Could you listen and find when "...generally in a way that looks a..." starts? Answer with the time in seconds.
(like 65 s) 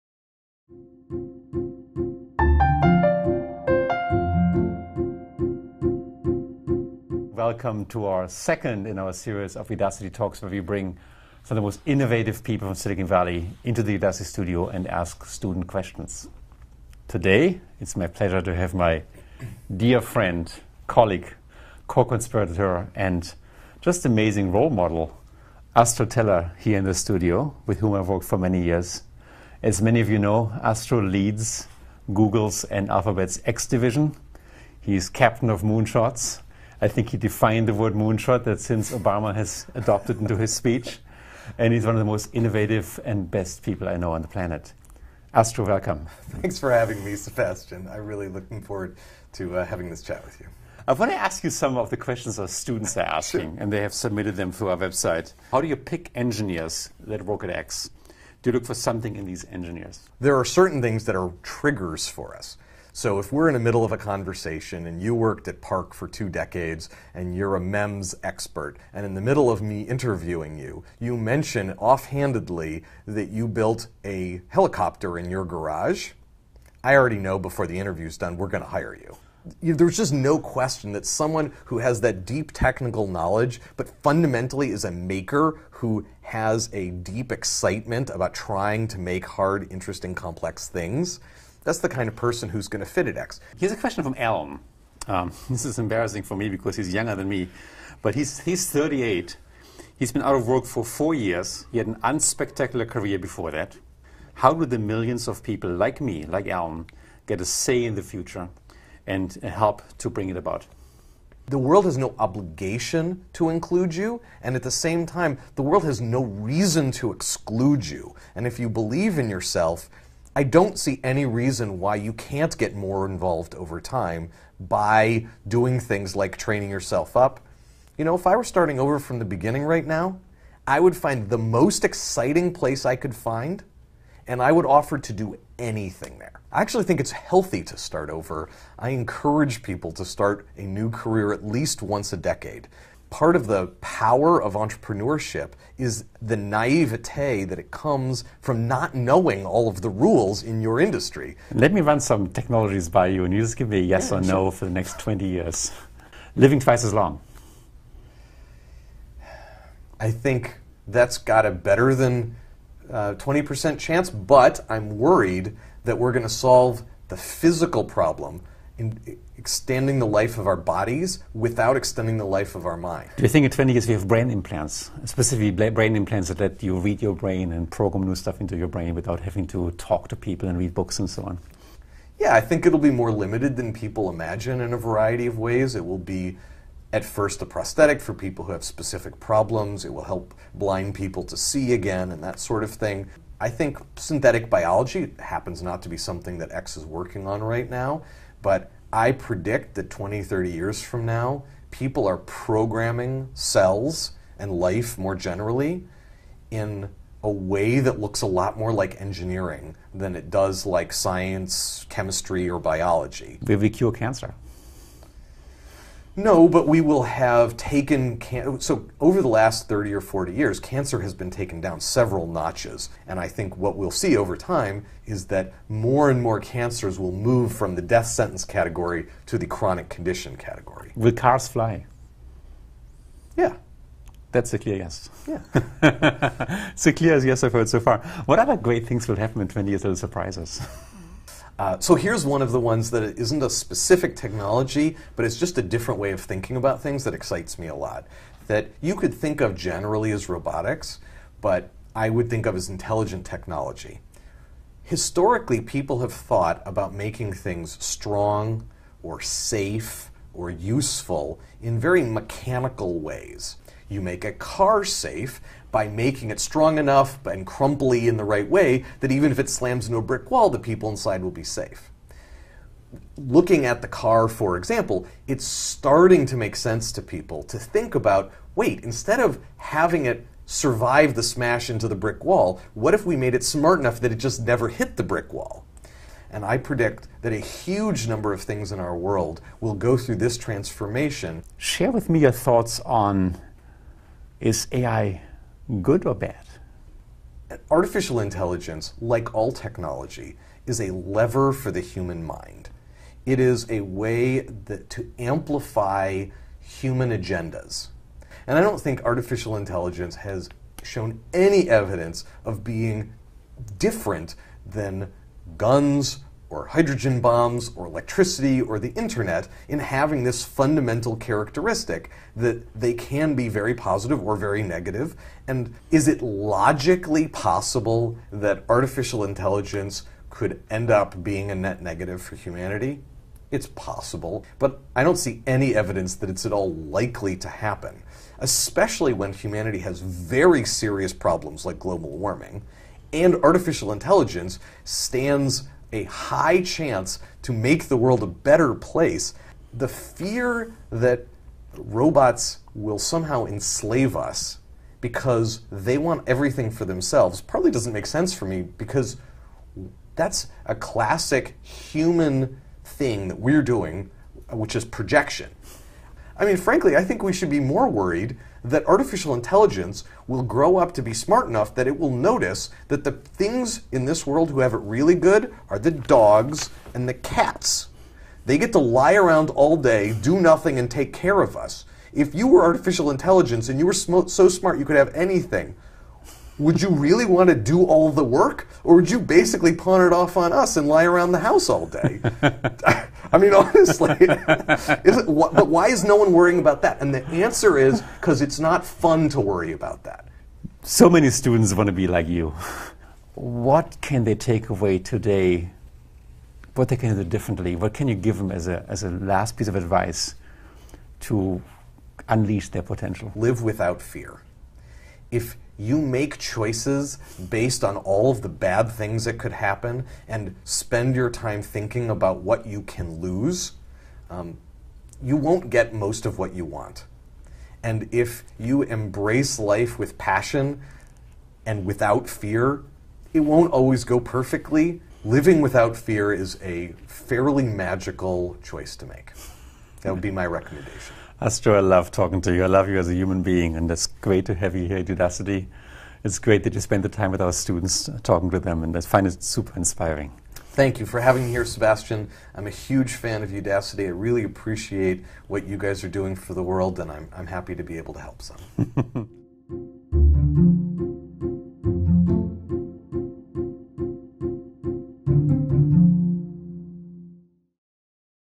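205 s.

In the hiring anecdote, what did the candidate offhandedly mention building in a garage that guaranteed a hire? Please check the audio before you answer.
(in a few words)
a helicopter.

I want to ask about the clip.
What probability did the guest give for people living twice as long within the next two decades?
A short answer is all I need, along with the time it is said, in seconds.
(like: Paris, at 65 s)
better than 20%, at 161 s.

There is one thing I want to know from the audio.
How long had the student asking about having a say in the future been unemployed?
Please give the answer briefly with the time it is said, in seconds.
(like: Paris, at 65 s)
4 years, at 100 s.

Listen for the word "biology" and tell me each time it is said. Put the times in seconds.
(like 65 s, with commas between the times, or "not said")
194 s, 212 s.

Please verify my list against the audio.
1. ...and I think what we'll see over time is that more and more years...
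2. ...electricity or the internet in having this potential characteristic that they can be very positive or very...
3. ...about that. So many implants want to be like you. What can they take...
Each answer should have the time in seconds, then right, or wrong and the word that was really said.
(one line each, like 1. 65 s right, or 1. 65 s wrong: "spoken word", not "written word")
1. 223 s wrong: "cancers", not "years"
2. 317 s wrong: "fundamental", not "potential"
3. 399 s wrong: "students", not "implants".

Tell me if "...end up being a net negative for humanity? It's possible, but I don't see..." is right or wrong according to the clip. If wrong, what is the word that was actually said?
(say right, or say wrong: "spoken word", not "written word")
right.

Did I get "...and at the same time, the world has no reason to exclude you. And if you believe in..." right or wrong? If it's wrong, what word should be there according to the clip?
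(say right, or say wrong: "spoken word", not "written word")
right.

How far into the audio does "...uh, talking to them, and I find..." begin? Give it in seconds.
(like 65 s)
448 s.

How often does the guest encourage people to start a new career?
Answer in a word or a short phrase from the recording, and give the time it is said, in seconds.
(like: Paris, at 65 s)
once a decade, at 141 s.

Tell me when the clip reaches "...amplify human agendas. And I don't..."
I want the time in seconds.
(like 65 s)
305 s.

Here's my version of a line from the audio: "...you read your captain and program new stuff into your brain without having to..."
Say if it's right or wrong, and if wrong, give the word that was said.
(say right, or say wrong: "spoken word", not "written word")
wrong: "brain", not "captain".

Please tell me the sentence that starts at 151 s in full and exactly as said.
Let me run some technologies by you and you just give me a yes yeah, or sure.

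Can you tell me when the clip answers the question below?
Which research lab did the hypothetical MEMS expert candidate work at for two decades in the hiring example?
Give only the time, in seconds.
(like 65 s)
65 s.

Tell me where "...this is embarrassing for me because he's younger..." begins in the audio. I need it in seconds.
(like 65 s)
95 s.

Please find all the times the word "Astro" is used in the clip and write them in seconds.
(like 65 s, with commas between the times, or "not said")
25 s, 30 s, 45 s, 441 s.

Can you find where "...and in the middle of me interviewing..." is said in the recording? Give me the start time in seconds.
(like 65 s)
68 s.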